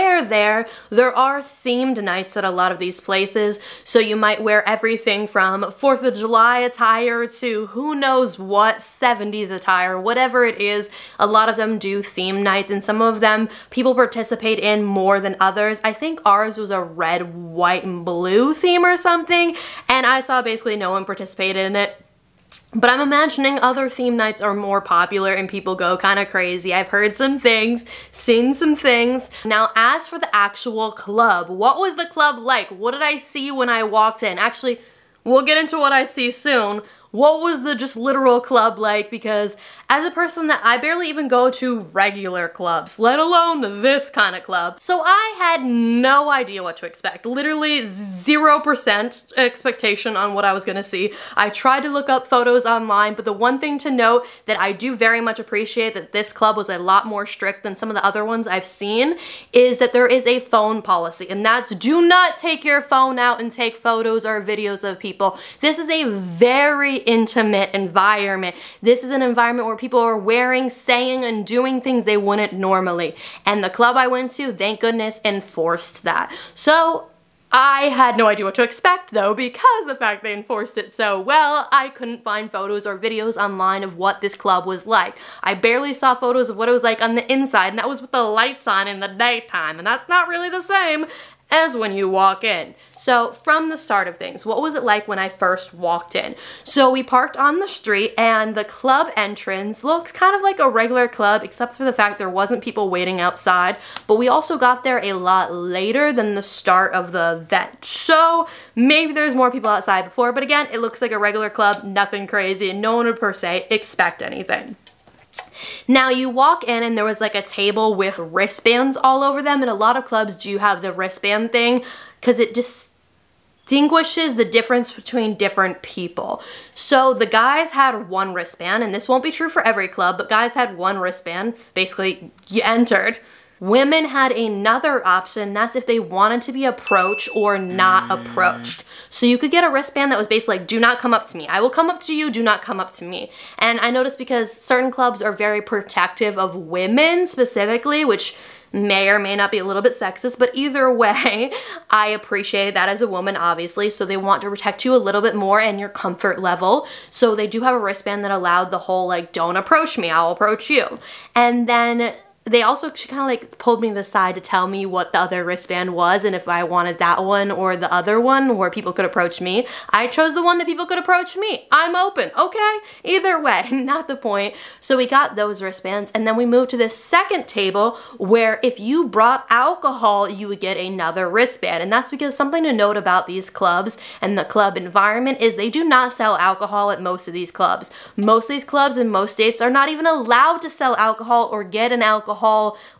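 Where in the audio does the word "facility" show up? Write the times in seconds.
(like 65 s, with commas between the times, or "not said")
not said.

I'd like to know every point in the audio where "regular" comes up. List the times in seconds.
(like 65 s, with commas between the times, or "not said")
41 s, 100 s, 111 s.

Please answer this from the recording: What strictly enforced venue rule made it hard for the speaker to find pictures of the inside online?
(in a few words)
phone policy.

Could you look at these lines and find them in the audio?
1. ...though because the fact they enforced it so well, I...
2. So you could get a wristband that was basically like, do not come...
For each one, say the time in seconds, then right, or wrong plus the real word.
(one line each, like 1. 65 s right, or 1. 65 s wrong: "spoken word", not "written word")
1. 79 s right
2. 139 s right.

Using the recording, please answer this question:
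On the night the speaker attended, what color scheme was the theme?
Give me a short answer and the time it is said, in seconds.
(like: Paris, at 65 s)
red, white, and blue, at 16 s.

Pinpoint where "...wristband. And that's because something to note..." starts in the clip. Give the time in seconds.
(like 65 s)
181 s.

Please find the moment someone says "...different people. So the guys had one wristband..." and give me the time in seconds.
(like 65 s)
125 s.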